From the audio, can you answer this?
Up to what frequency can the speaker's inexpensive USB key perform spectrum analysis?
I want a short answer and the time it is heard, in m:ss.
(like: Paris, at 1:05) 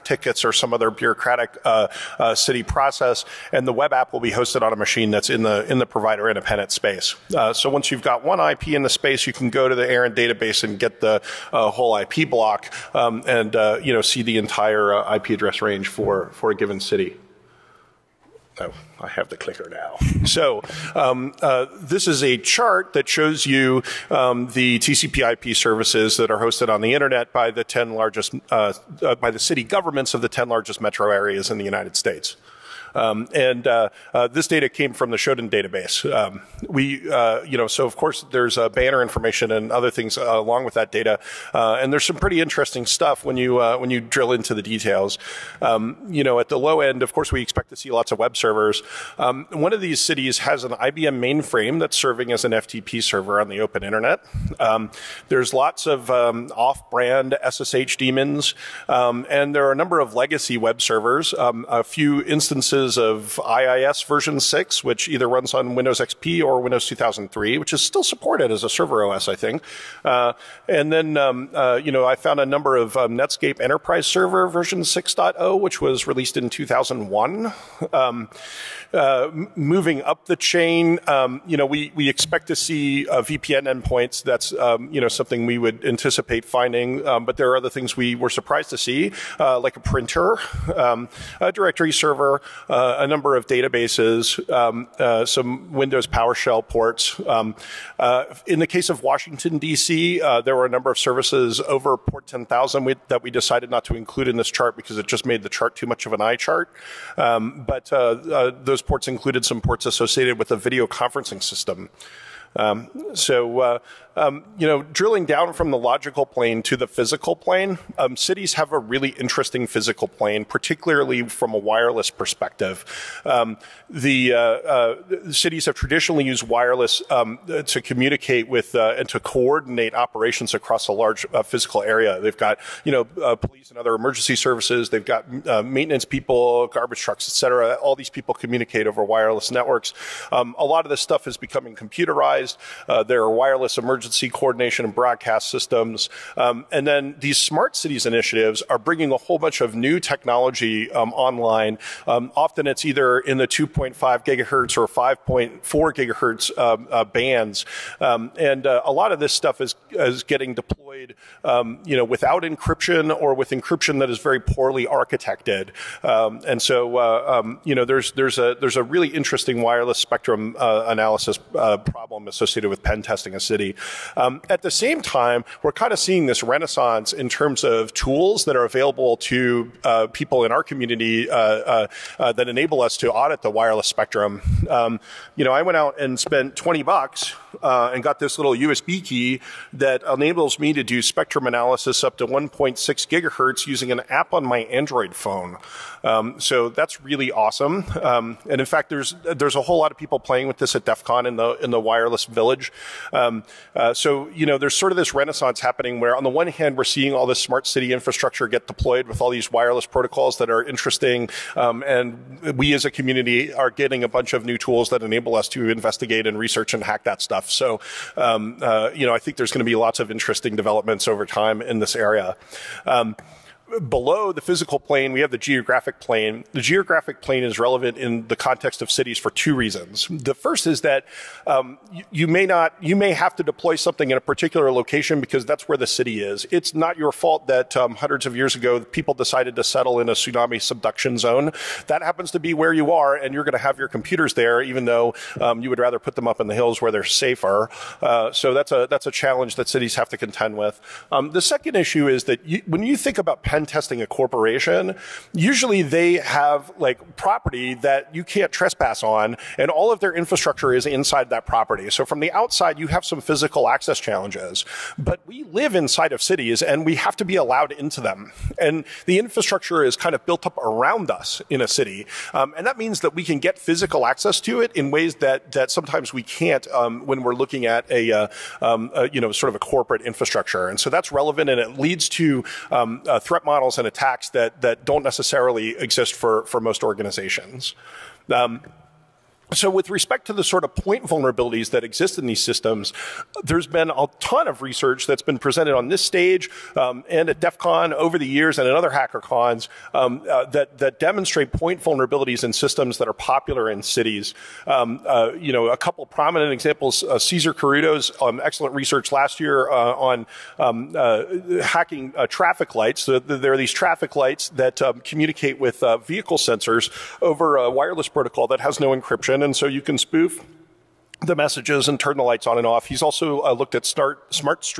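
1.6 gigahertz, at 3:12.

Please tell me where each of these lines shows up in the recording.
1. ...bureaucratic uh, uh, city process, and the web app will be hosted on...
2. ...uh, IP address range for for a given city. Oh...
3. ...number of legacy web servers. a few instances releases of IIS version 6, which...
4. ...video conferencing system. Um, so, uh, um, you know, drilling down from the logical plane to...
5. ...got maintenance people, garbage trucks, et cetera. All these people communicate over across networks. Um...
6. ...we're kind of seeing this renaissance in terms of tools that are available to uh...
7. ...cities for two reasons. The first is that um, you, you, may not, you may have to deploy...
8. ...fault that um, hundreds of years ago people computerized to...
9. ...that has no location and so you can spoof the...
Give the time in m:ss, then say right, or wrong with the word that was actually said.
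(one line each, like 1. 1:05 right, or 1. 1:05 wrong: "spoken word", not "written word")
1. 0:00 right
2. 0:14 right
3. 0:59 right
4. 1:50 right
5. 2:15 wrong: "wireless", not "across"
6. 2:55 right
7. 3:48 right
8. 3:57 wrong: "decided", not "computerized"
9. 5:18 wrong: "encryption", not "location".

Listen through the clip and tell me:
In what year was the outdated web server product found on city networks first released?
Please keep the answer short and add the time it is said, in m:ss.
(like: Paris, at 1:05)
2001, at 1:16.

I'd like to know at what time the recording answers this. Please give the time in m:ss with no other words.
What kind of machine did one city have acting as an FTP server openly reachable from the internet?
0:50.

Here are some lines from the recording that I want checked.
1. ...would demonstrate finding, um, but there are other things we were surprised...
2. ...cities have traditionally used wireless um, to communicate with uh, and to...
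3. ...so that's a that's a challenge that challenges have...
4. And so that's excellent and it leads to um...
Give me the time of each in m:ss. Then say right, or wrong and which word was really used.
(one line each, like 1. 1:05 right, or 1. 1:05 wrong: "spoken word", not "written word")
1. 1:25 wrong: "anticipate", not "demonstrate"
2. 2:05 right
3. 4:08 wrong: "cities", not "challenges"
4. 4:40 wrong: "relevant", not "excellent".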